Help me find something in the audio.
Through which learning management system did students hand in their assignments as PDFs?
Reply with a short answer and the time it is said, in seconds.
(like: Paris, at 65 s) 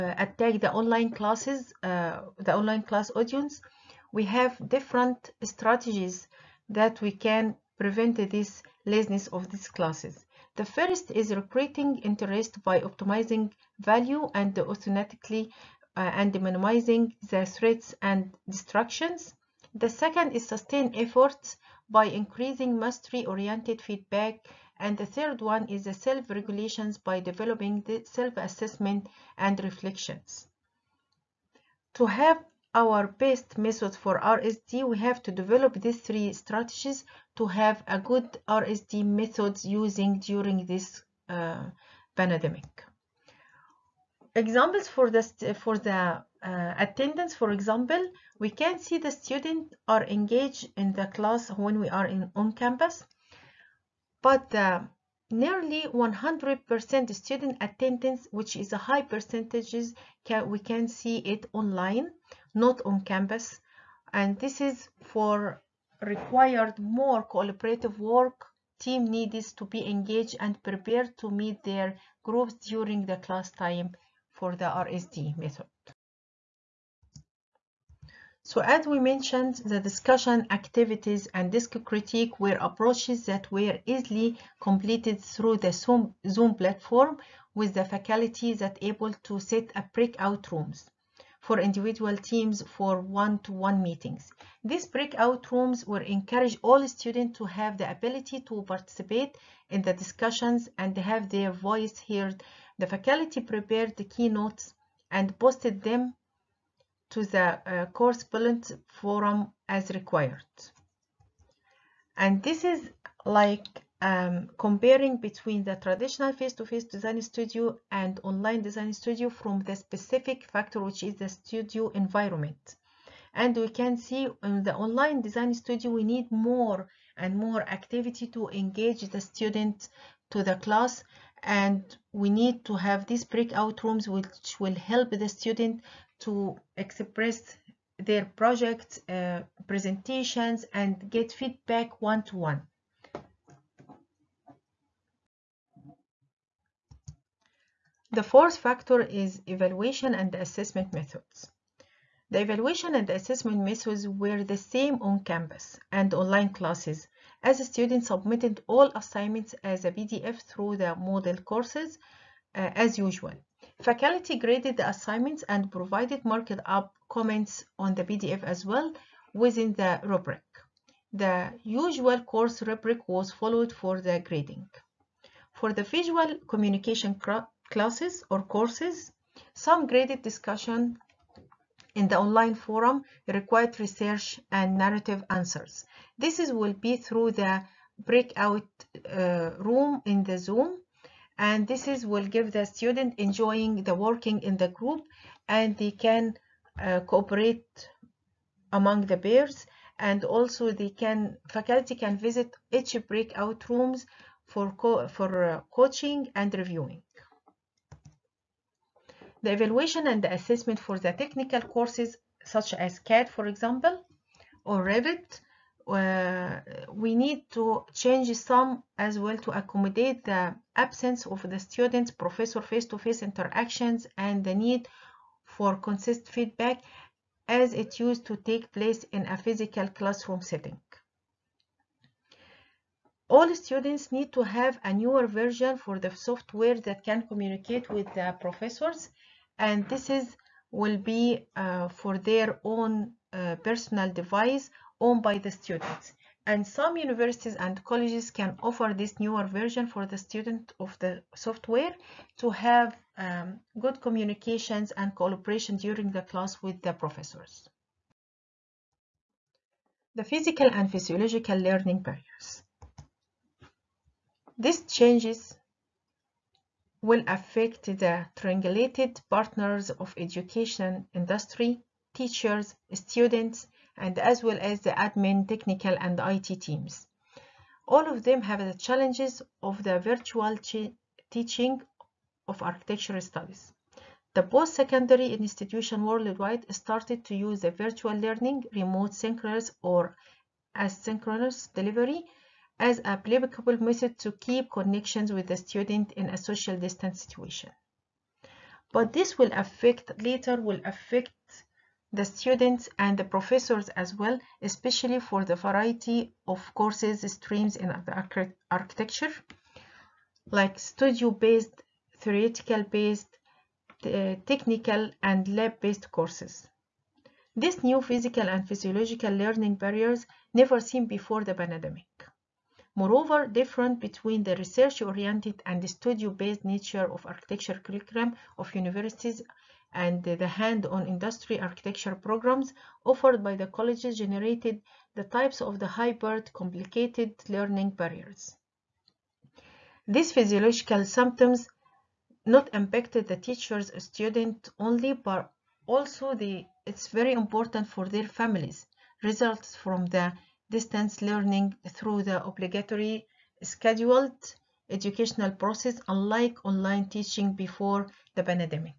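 Moodle, at 160 s.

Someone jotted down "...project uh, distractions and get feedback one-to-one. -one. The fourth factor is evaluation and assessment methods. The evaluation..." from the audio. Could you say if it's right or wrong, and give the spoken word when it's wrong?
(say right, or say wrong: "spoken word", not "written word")
wrong: "presentations", not "distractions".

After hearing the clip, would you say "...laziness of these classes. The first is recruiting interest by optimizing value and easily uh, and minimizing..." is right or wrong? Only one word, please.
wrong.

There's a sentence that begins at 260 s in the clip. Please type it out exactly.
The physical and physiological learning barriers.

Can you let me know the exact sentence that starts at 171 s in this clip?
The usual course rubric was followed for the grading.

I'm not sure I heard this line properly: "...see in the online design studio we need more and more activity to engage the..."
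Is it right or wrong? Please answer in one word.
right.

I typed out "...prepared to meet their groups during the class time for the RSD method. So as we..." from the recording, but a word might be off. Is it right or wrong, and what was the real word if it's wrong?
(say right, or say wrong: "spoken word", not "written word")
right.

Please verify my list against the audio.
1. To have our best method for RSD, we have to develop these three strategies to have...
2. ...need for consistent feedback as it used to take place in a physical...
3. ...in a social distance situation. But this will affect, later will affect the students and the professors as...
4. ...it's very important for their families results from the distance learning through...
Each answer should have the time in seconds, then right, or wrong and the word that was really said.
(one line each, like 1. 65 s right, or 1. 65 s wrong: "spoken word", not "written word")
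1. 31 s right
2. 224 s right
3. 296 s right
4. 346 s right.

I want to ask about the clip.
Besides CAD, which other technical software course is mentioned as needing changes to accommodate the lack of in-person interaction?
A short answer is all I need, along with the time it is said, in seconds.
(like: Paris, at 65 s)
Revit, at 214 s.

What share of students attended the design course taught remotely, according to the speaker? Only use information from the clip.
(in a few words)
100%.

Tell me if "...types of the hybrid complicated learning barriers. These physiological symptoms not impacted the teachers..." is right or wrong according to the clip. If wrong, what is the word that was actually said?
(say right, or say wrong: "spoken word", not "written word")
right.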